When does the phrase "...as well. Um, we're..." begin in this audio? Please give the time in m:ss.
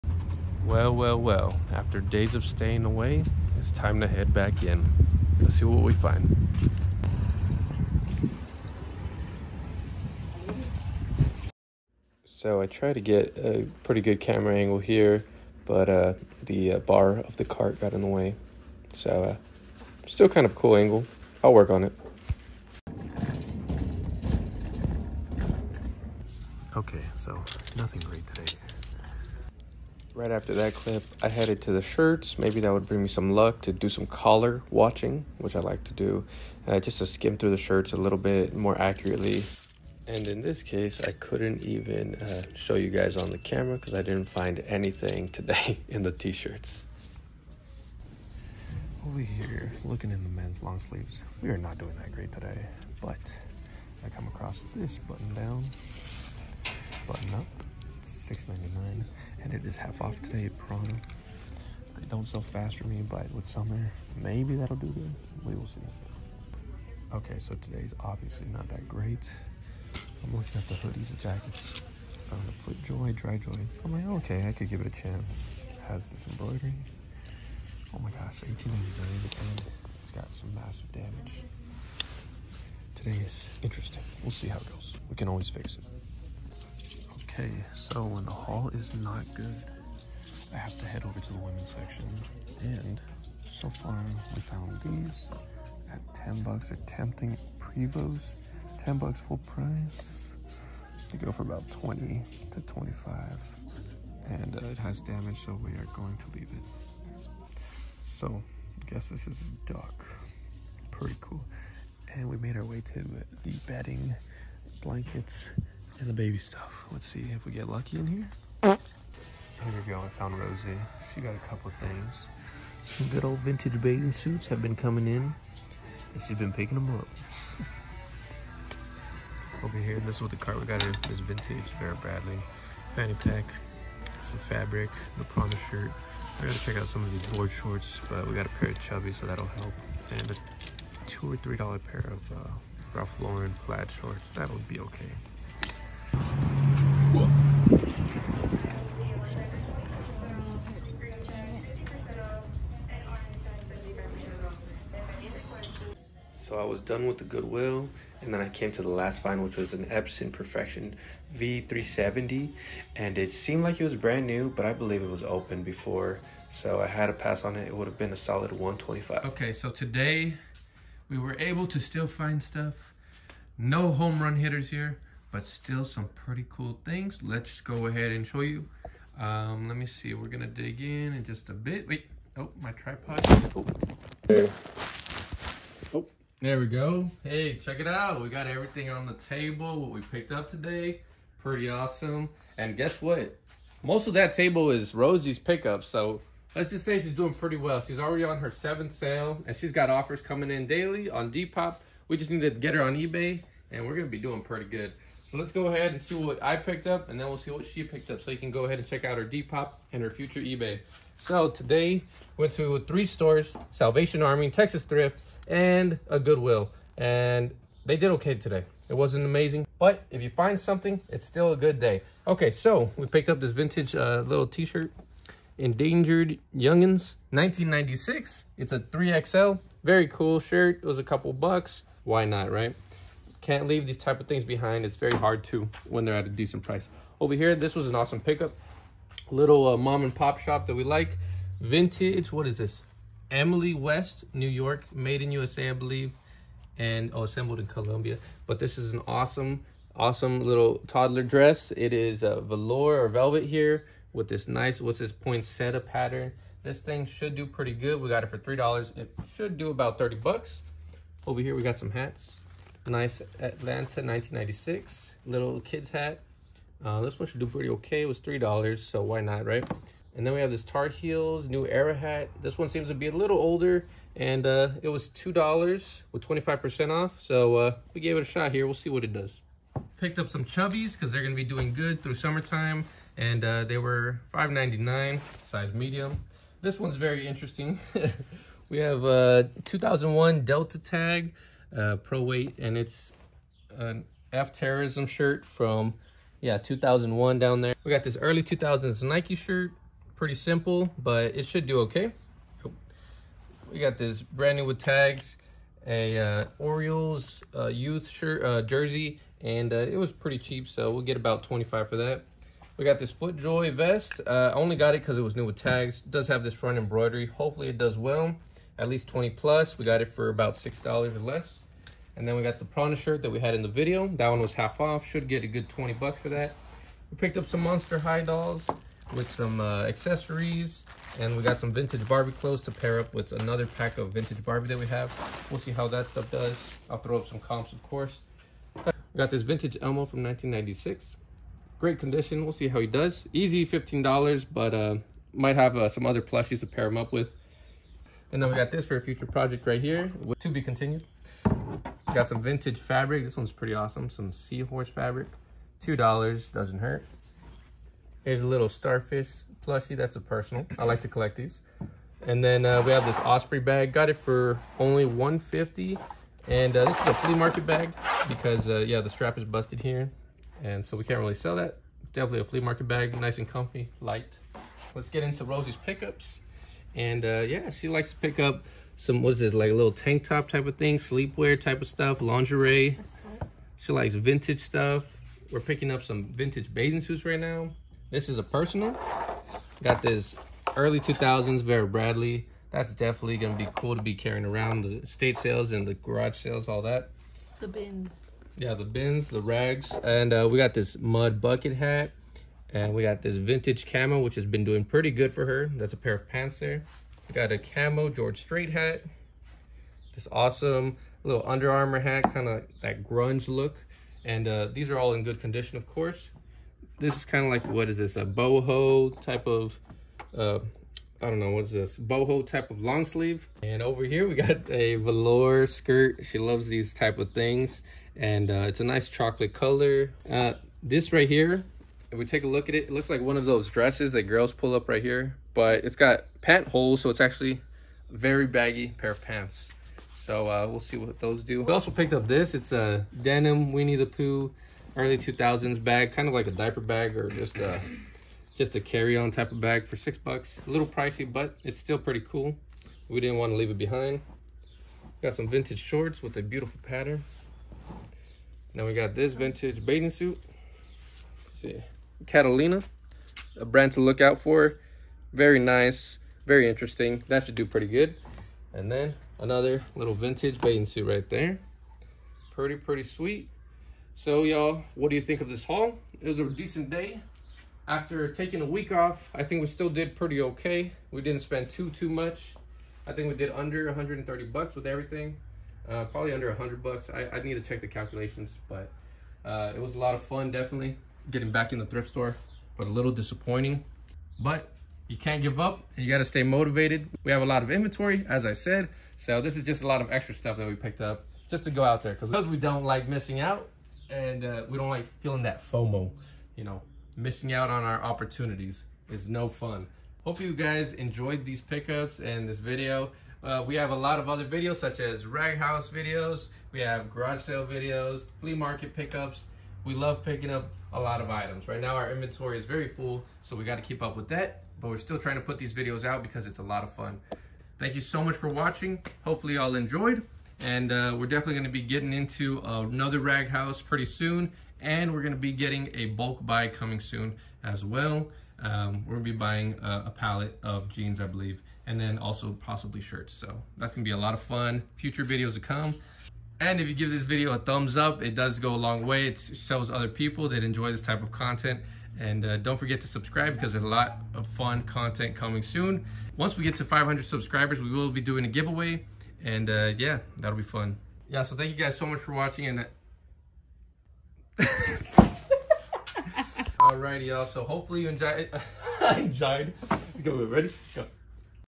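8:57.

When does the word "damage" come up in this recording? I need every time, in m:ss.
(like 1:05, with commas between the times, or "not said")
1:20, 1:44.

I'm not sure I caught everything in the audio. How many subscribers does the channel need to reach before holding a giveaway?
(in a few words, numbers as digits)
500.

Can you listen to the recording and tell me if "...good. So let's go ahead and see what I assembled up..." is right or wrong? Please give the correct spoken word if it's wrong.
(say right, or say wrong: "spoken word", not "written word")
wrong: "picked", not "assembled".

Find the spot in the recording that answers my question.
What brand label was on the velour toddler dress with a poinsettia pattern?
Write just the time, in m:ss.
4:03.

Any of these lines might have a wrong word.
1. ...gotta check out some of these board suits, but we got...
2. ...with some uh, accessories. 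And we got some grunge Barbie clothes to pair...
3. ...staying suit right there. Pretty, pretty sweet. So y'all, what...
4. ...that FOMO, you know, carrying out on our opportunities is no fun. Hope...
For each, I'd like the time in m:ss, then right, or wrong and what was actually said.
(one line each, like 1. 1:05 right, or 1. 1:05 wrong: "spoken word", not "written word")
1. 2:16 wrong: "shorts", not "suits"
2. 5:29 wrong: "vintage", not "grunge"
3. 7:50 wrong: "bathing", not "staying"
4. 8:25 wrong: "missing", not "carrying".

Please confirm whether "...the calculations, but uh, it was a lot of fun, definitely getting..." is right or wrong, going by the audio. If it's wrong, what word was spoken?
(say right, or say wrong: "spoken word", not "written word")
right.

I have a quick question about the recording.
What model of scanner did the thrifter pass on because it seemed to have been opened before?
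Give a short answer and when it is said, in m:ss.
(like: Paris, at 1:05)
Epson Perfection V370, at 2:39.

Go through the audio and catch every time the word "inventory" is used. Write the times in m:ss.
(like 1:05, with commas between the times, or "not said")
8:17, 8:42.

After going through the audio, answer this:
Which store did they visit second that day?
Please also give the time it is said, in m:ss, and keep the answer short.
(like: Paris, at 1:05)
Texas Thrift, at 3:34.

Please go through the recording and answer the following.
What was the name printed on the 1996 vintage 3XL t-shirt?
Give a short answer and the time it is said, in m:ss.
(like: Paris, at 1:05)
Endangered Youngins, at 3:45.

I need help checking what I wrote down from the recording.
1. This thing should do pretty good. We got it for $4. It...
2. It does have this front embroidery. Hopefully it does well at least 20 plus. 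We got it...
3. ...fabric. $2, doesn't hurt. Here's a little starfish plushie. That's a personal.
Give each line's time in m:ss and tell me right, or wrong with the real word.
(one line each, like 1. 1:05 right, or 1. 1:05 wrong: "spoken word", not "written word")
1. 4:16 wrong: "3", not "4"
2. 5:16 right
3. 5:54 right.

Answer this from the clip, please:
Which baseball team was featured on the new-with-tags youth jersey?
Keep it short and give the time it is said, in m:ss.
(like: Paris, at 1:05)
Orioles, at 5:06.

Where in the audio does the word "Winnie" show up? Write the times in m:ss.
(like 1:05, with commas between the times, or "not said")
7:23.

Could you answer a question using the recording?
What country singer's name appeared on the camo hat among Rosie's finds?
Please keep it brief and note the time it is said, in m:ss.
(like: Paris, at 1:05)
George Strait, at 6:48.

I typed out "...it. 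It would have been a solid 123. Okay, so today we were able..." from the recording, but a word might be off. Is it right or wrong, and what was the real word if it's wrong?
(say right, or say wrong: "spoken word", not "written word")
wrong: "125", not "123".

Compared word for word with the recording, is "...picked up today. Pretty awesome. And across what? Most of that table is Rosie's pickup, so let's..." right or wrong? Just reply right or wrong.
wrong.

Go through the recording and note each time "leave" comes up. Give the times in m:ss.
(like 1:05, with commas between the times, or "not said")
1:46, 3:53, 7:33.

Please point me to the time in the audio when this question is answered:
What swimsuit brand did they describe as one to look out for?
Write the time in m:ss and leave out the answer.
7:42.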